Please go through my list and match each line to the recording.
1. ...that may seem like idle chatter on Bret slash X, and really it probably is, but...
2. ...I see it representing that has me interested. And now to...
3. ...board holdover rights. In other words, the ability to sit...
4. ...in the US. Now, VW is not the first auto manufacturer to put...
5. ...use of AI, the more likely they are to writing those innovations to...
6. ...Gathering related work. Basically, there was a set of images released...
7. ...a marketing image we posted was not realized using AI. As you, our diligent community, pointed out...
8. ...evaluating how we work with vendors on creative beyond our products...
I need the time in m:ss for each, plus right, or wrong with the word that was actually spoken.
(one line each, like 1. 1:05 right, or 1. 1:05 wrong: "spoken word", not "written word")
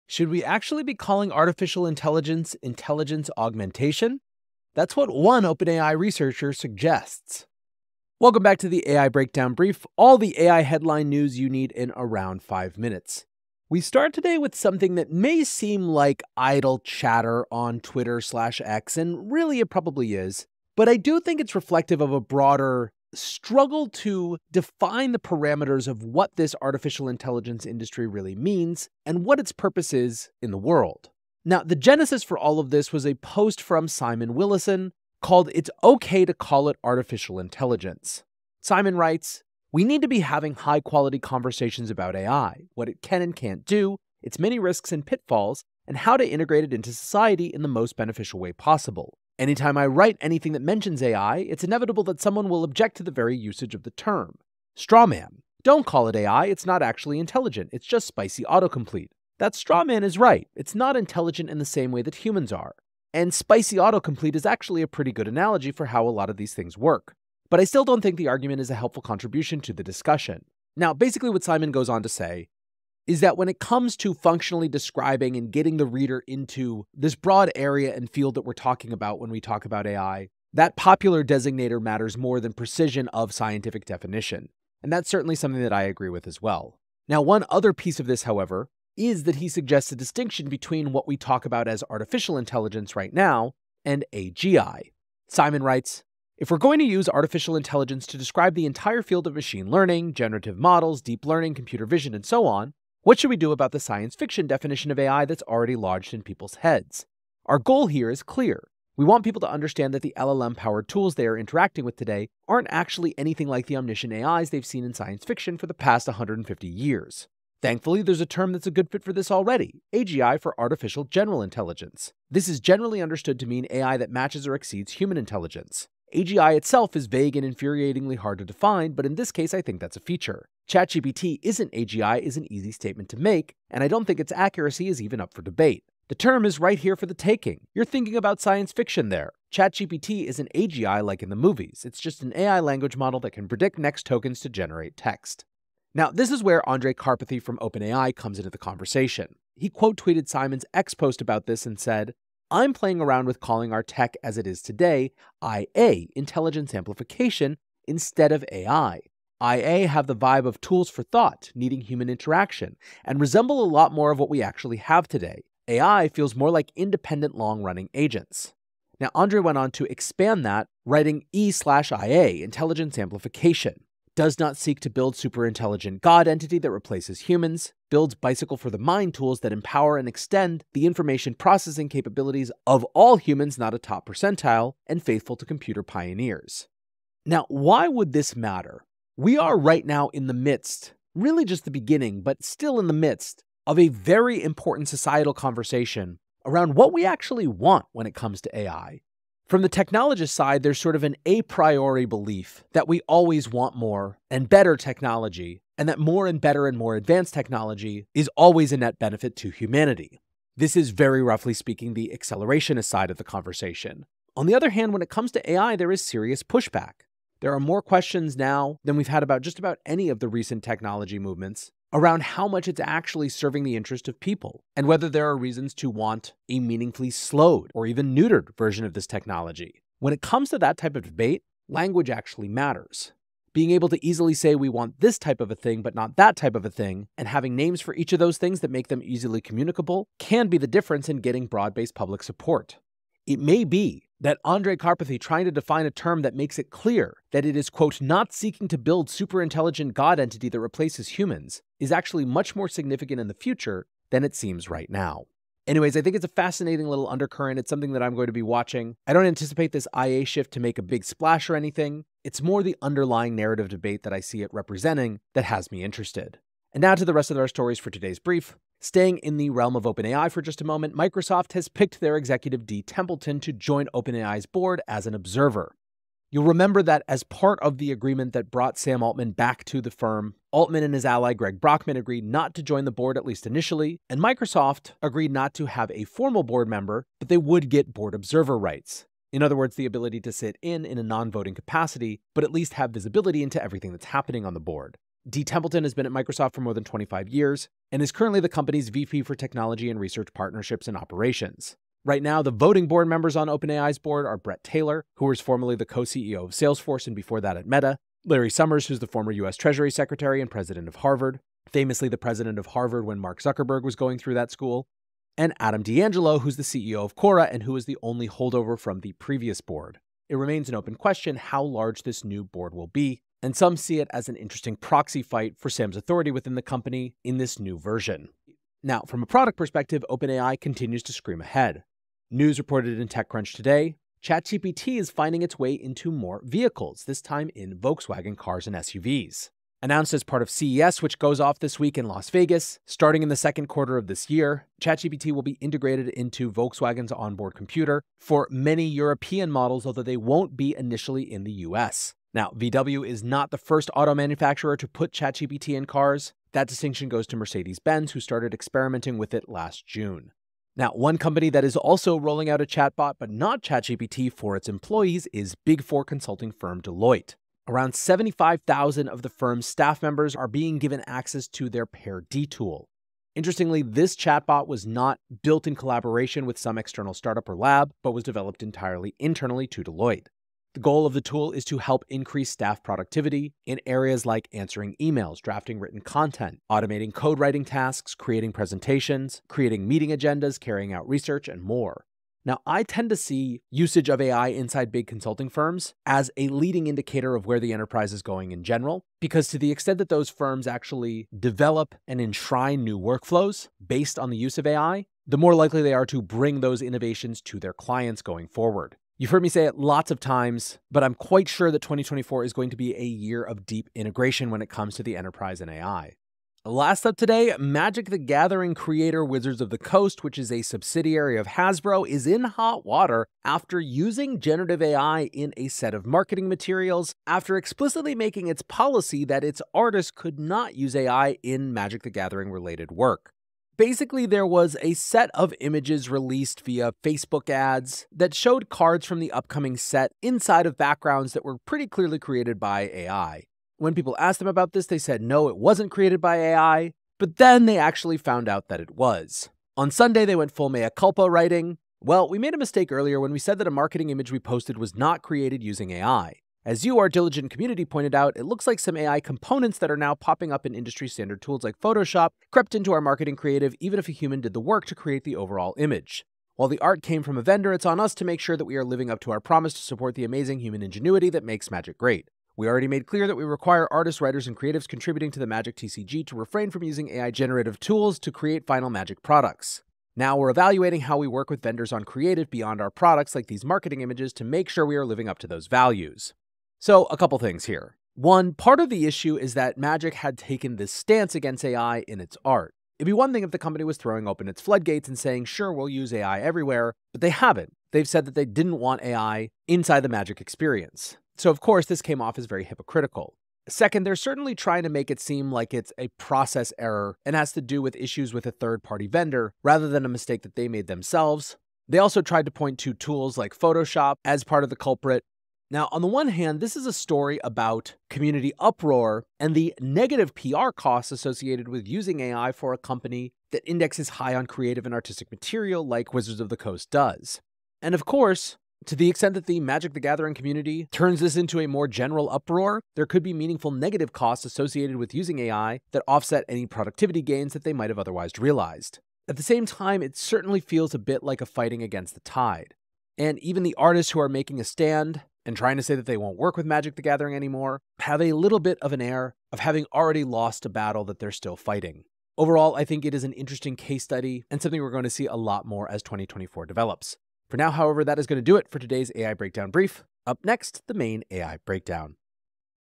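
1. 0:14 wrong: "Twitter", not "Bret"
2. 4:24 right
3. 4:47 wrong: "observer", not "holdover"
4. 5:51 right
5. 6:44 wrong: "bring", not "writing"
6. 7:12 right
7. 7:33 wrong: "created", not "realized"
8. 8:00 right.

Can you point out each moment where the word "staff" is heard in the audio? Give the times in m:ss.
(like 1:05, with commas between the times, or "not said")
6:09, 6:22.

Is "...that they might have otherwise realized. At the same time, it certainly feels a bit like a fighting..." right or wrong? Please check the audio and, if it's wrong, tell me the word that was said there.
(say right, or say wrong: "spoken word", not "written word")
right.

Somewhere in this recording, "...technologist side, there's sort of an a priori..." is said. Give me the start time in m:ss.
3:19.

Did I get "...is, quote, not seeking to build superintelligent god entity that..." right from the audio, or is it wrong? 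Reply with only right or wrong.
right.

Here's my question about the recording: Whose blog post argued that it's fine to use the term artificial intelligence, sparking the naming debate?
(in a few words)
Simon Willison.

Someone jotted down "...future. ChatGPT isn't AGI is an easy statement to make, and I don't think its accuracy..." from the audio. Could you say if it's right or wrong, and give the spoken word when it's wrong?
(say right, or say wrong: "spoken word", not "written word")
wrong: "feature", not "future".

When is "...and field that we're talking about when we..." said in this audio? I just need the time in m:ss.
1:17.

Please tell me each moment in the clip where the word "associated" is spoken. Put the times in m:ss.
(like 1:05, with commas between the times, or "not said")
8:41, 8:54.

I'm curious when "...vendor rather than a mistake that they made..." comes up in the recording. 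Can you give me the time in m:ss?
8:29.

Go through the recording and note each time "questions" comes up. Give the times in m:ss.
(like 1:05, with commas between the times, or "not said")
3:37, 5:20.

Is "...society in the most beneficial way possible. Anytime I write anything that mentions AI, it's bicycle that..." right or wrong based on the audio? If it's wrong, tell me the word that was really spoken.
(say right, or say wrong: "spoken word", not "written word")
wrong: "inevitable", not "bicycle".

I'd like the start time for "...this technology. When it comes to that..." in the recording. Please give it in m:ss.
3:48.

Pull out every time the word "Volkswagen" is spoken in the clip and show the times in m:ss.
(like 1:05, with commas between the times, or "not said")
5:37, 5:46.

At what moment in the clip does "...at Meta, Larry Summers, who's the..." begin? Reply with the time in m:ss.
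5:07.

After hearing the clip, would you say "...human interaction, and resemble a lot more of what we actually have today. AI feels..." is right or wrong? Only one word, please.
right.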